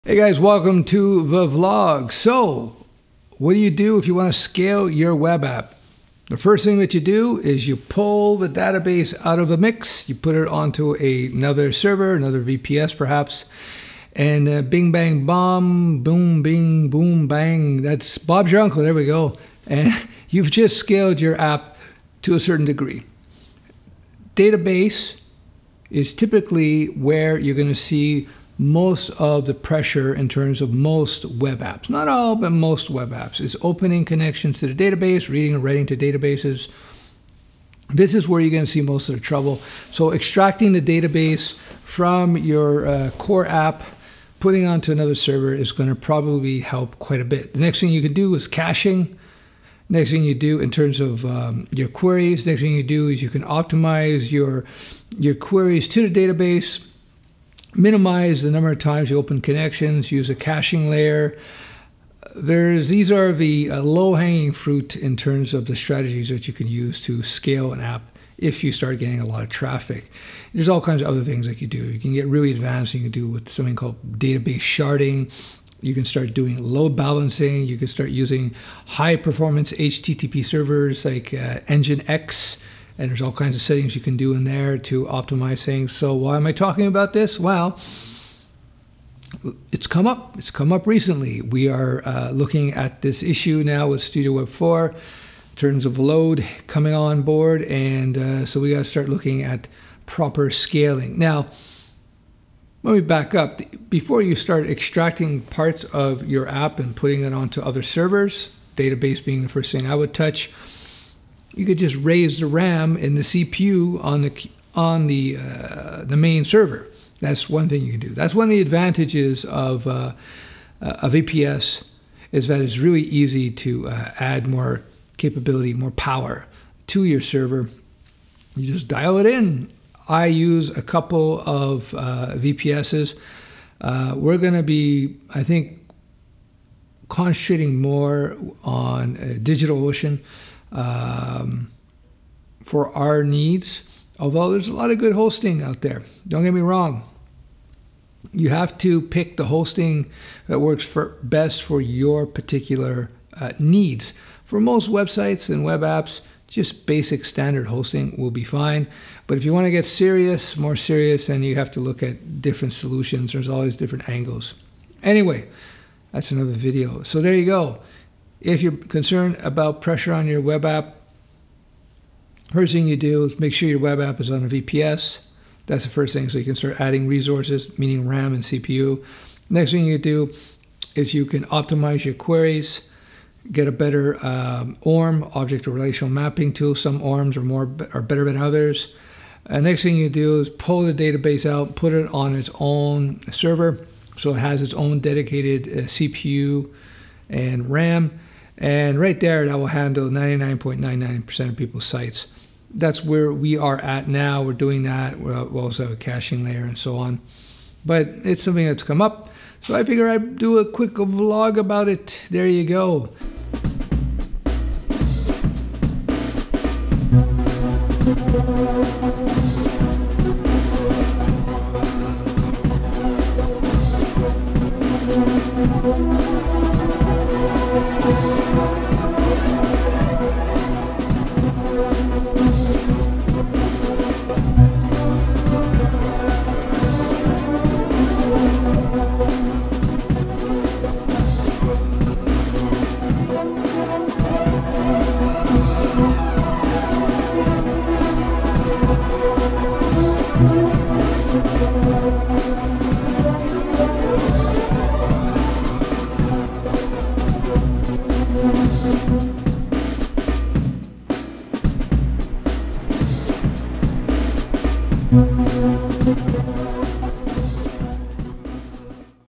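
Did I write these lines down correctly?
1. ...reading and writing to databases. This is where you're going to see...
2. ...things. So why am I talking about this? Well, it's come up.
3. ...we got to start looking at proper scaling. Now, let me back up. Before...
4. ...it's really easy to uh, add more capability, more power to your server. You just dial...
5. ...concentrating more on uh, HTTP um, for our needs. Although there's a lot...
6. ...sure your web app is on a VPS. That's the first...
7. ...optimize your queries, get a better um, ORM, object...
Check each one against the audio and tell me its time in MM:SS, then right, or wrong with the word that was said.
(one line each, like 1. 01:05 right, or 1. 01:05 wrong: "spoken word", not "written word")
1. 00:35 right
2. 01:25 right
3. 01:38 right
4. 02:02 right
5. 02:17 wrong: "DigitalOcean", not "HTTP"
6. 02:53 right
7. 03:01 right.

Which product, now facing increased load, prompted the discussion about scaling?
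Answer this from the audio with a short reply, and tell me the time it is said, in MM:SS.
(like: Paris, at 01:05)
Studio Web 4, at 01:34.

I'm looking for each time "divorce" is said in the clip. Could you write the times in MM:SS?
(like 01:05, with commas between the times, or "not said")
not said.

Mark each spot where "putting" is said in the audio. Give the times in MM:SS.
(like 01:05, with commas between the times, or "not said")
00:44, 01:46.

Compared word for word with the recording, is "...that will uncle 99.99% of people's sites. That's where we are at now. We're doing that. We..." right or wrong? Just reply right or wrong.
wrong.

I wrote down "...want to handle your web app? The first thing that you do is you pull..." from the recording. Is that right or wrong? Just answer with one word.
wrong.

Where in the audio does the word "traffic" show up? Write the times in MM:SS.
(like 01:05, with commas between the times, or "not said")
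01:09.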